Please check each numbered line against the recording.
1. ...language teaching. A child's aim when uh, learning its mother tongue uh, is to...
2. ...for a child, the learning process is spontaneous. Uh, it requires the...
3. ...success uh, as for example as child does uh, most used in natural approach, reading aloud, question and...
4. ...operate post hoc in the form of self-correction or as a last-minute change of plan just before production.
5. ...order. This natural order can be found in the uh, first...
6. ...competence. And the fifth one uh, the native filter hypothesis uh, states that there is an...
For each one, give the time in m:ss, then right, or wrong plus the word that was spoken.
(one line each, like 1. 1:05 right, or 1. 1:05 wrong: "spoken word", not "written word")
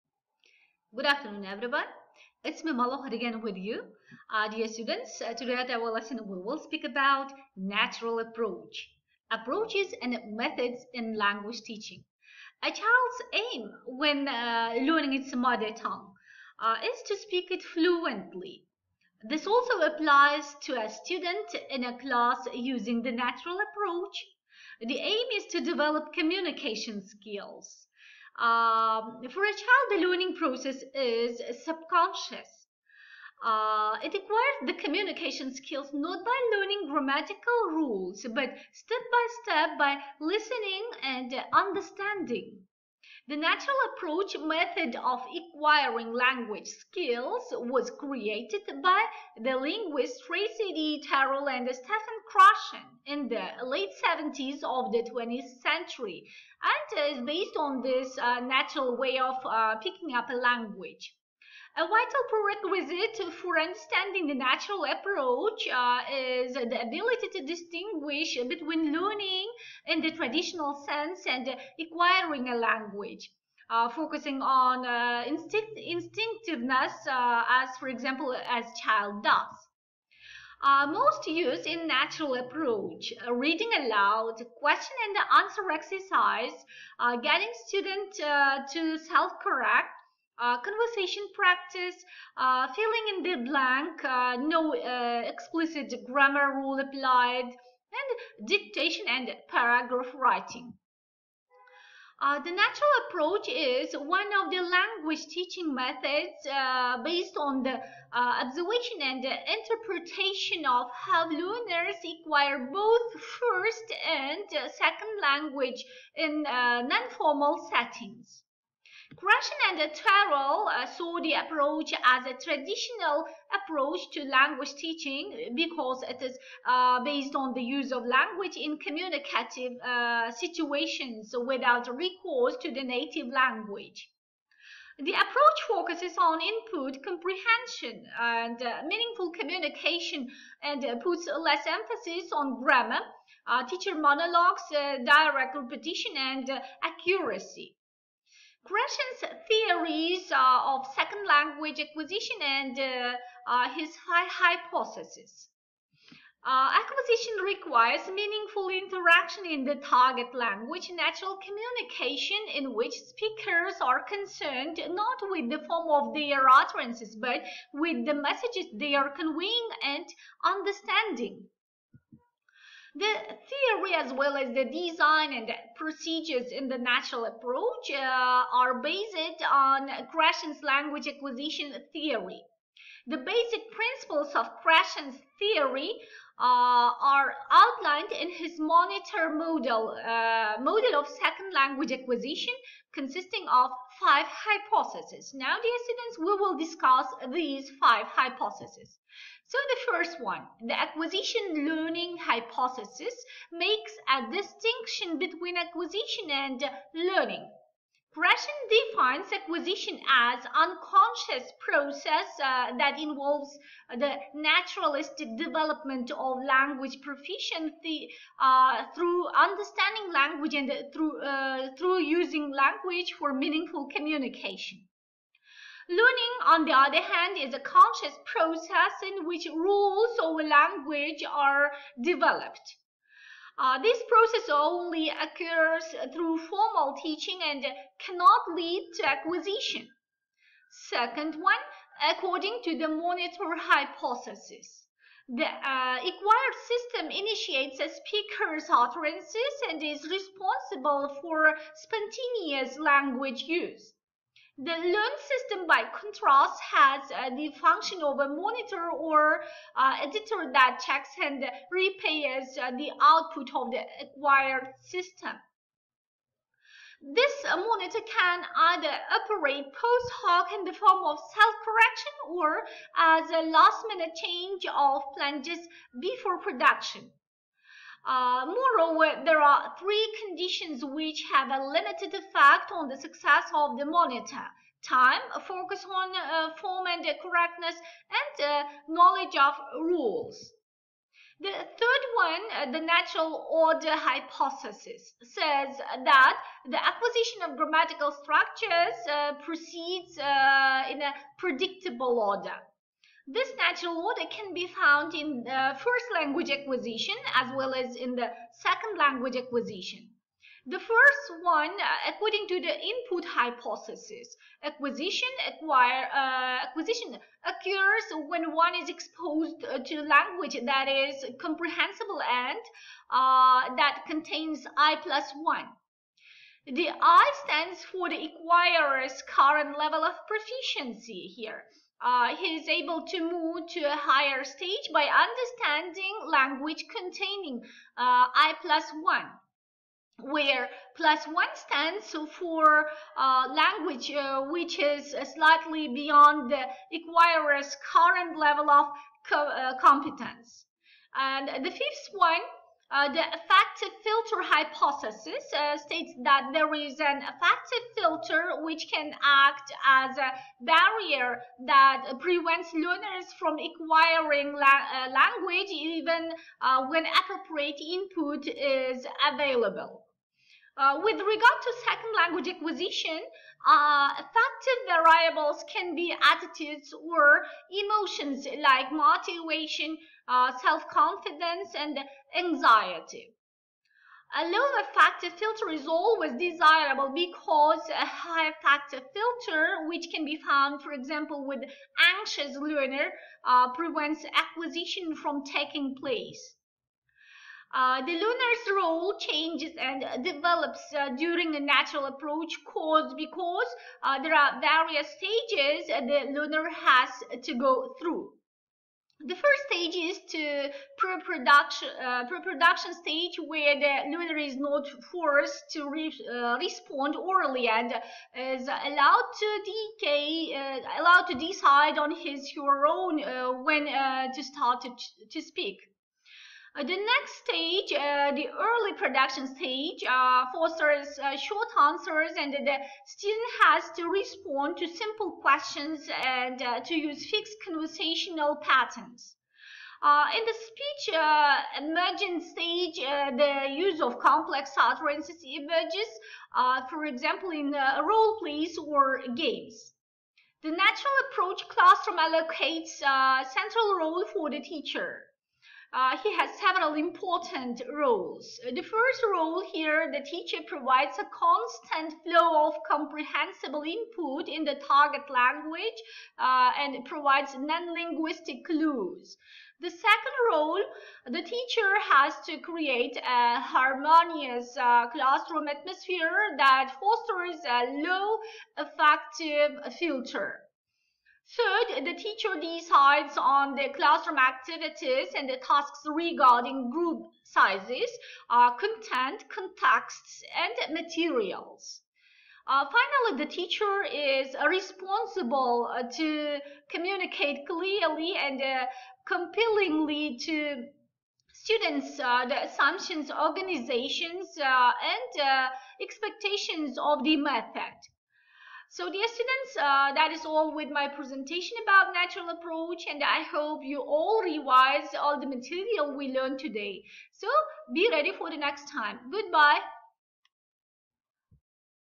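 1. 0:11 right
2. 0:29 wrong: "subconscious", not "spontaneous"
3. 1:15 wrong: "instinctiveness", not "success"
4. 4:29 right
5. 5:02 right
6. 5:49 wrong: "affective", not "native".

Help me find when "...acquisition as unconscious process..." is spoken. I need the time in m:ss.
3:29.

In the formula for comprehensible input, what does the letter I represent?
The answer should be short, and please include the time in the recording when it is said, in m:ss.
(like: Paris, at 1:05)
current level of proficiency, at 5:29.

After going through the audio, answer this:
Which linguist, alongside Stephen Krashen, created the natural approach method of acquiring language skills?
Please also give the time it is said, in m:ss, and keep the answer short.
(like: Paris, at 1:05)
Tracy D. Terrell, at 0:50.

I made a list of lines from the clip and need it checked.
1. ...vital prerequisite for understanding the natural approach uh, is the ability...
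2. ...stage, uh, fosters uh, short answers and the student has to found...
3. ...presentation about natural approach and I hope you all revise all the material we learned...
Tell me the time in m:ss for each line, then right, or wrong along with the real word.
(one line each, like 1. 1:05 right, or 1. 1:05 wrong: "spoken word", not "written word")
1. 1:01 right
2. 7:09 wrong: "respond", not "found"
3. 8:31 right.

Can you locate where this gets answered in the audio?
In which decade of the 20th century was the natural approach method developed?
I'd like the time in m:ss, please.
0:53.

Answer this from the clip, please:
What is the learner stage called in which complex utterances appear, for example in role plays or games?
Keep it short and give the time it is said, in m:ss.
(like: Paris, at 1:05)
speech emergent stage, at 7:20.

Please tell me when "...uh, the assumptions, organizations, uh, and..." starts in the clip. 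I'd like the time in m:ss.
8:22.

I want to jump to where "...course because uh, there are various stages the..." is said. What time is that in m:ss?
6:42.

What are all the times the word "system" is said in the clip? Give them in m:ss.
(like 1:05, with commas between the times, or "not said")
4:06, 4:15, 4:24.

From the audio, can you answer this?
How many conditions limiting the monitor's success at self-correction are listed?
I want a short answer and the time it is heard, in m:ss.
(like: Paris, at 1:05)
3, at 4:39.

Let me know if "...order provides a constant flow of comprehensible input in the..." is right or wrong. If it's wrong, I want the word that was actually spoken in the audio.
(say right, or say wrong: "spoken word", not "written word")
wrong: "teacher", not "order".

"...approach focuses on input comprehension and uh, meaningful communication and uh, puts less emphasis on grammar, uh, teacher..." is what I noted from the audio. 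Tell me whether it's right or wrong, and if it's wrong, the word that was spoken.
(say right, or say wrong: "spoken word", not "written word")
right.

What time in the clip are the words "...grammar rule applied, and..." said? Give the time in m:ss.
1:36.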